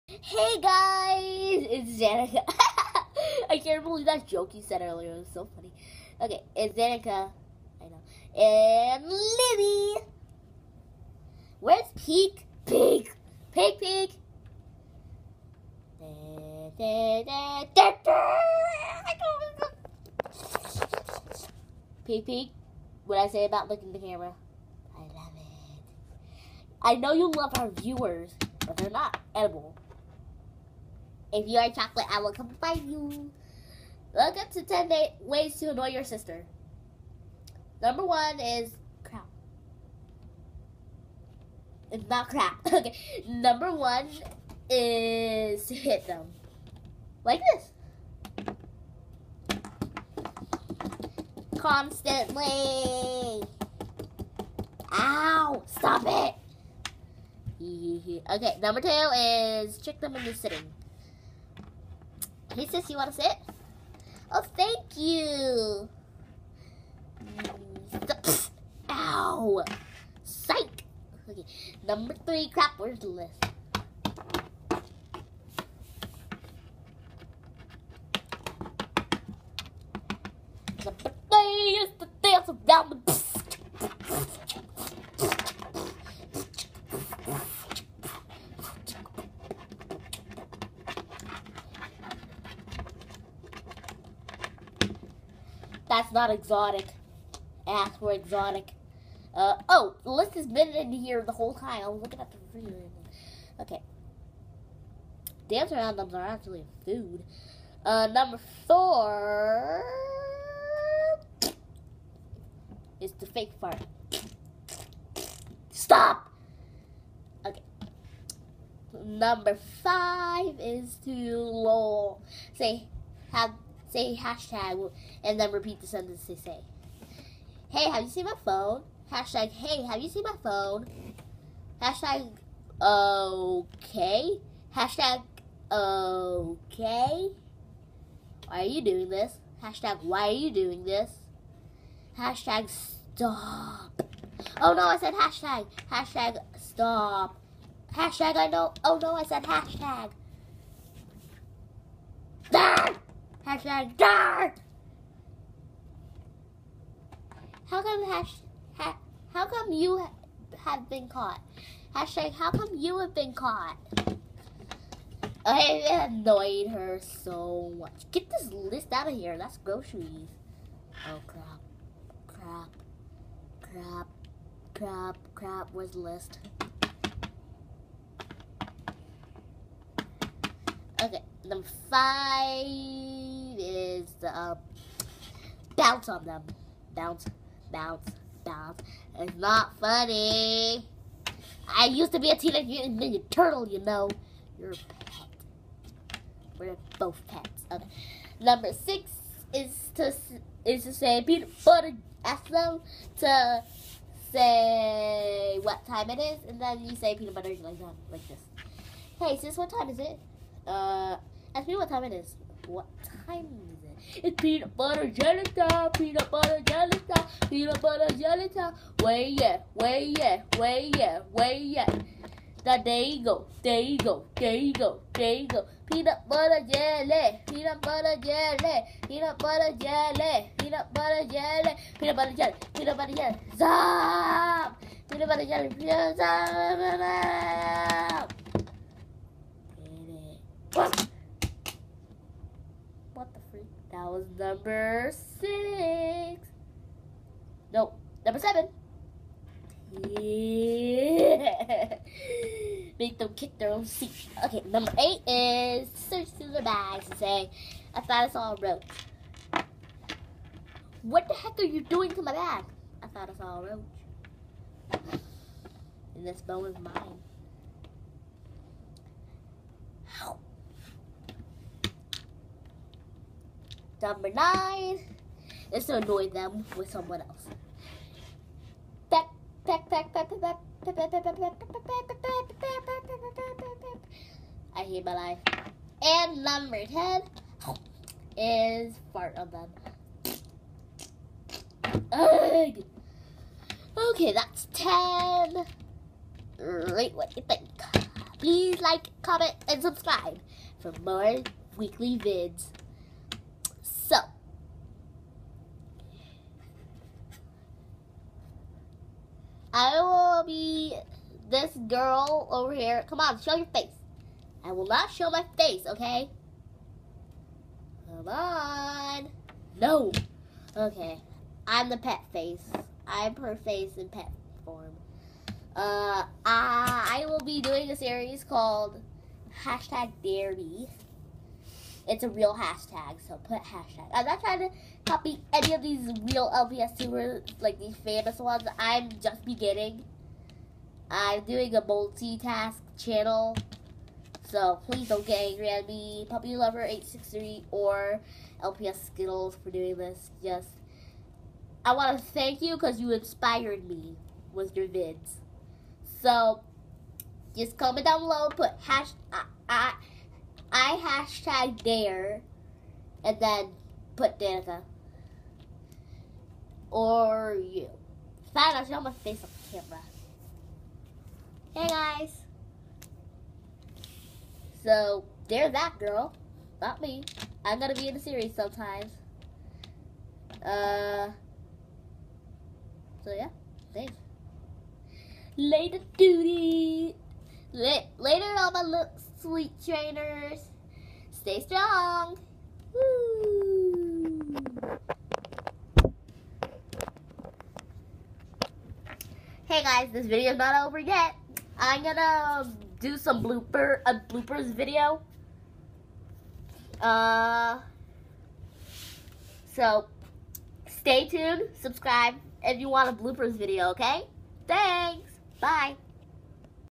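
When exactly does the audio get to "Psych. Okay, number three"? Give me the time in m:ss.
1:10.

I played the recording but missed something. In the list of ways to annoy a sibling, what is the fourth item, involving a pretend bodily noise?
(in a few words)
The fake fart.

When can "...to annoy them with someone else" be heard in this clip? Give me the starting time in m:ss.
4:35.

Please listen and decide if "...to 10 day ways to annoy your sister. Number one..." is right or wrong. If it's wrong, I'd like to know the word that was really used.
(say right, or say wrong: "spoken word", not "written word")
right.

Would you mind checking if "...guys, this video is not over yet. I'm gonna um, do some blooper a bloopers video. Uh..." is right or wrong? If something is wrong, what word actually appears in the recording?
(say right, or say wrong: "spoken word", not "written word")
right.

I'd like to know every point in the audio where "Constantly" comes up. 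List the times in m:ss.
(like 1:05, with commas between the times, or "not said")
0:51.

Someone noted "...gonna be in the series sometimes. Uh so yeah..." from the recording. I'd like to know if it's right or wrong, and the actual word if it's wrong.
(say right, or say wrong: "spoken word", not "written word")
right.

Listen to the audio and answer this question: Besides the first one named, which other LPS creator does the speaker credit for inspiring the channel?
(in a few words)
LPS Skittles.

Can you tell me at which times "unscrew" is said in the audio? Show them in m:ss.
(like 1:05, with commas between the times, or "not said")
not said.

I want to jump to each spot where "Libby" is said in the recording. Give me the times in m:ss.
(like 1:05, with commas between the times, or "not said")
0:09.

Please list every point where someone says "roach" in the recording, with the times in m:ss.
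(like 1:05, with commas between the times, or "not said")
4:18, 4:23.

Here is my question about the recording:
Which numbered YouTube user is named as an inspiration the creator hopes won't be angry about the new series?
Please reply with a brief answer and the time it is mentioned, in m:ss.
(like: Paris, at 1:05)
Puppy Lover 863, at 5:46.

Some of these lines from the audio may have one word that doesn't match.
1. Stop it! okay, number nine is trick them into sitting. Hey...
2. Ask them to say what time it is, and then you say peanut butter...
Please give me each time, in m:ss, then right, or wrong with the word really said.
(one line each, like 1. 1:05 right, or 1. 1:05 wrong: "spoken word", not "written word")
1. 0:55 wrong: "two", not "nine"
2. 3:22 right.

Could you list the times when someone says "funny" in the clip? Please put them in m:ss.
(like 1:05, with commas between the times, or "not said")
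0:05, 3:09.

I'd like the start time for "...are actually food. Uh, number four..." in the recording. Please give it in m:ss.
1:46.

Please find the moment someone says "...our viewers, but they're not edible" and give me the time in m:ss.
0:27.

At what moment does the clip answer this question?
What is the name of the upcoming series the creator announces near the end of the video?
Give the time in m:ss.
5:29.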